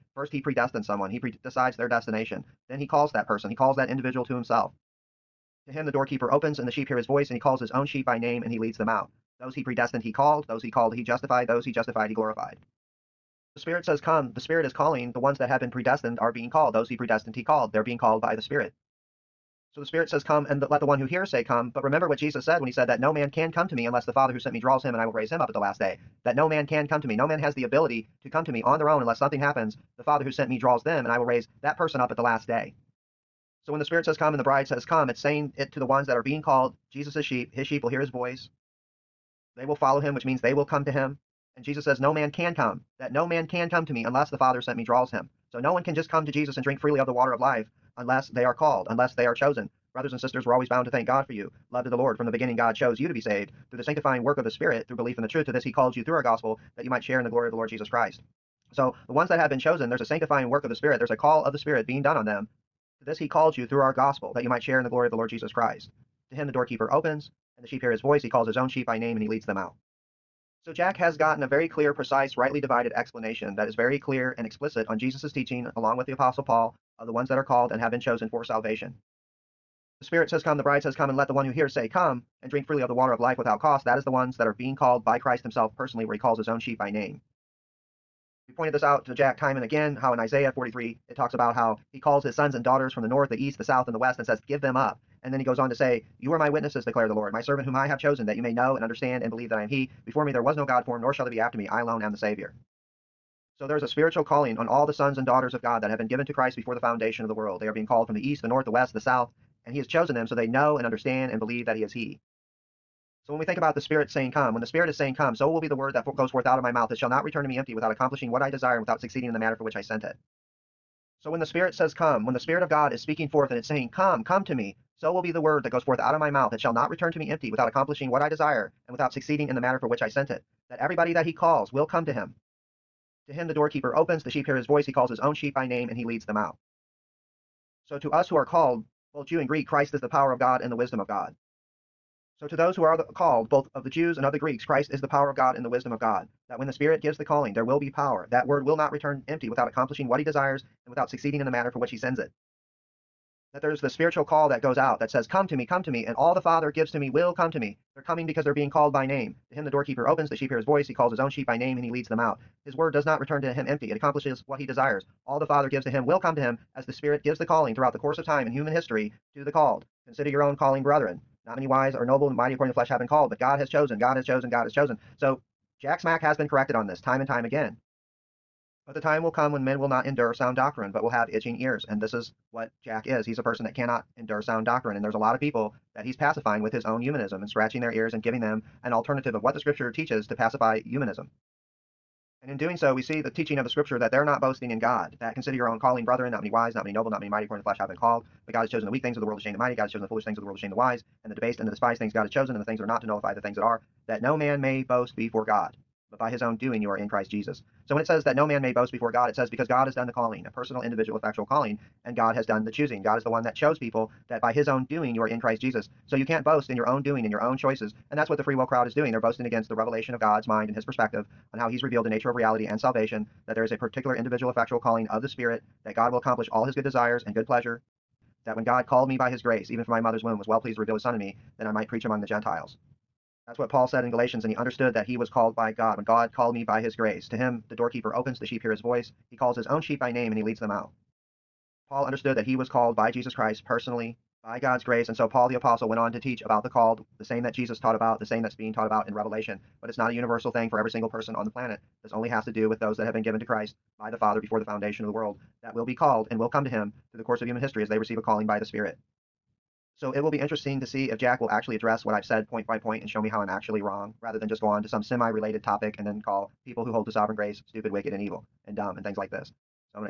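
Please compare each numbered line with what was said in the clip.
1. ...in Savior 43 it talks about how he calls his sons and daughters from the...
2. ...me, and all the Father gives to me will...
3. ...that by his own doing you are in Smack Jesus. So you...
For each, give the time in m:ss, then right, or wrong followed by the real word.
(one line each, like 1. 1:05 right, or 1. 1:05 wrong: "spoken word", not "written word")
1. 1:30 wrong: "Isaiah", not "Savior"
2. 2:35 right
3. 3:34 wrong: "Christ", not "Smack".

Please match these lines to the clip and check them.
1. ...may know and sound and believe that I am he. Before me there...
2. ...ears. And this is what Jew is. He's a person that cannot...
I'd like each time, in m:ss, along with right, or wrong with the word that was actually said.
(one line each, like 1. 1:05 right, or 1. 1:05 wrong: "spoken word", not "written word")
1. 1:38 wrong: "understand", not "sound"
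2. 3:01 wrong: "Jack", not "Jew".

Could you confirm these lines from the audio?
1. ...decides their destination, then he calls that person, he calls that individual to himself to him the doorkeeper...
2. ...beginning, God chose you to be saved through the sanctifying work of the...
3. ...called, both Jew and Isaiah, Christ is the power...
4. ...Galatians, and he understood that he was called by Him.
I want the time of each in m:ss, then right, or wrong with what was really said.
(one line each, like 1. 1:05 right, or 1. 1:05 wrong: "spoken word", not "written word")
1. 0:01 right
2. 0:52 right
3. 2:18 wrong: "Greek", not "Isaiah"
4. 3:54 wrong: "God", not "Him".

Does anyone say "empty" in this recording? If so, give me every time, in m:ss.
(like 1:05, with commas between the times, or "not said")
1:57, 2:07, 2:29, 2:43.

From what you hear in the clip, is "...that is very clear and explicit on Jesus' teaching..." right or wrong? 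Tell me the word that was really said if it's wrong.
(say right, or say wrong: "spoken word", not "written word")
right.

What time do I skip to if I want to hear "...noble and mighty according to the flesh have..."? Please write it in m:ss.
2:52.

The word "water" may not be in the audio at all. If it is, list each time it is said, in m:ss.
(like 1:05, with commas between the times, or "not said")
0:47, 1:22.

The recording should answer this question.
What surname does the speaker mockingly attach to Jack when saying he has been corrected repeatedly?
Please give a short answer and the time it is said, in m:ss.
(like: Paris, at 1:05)
Smack, at 2:55.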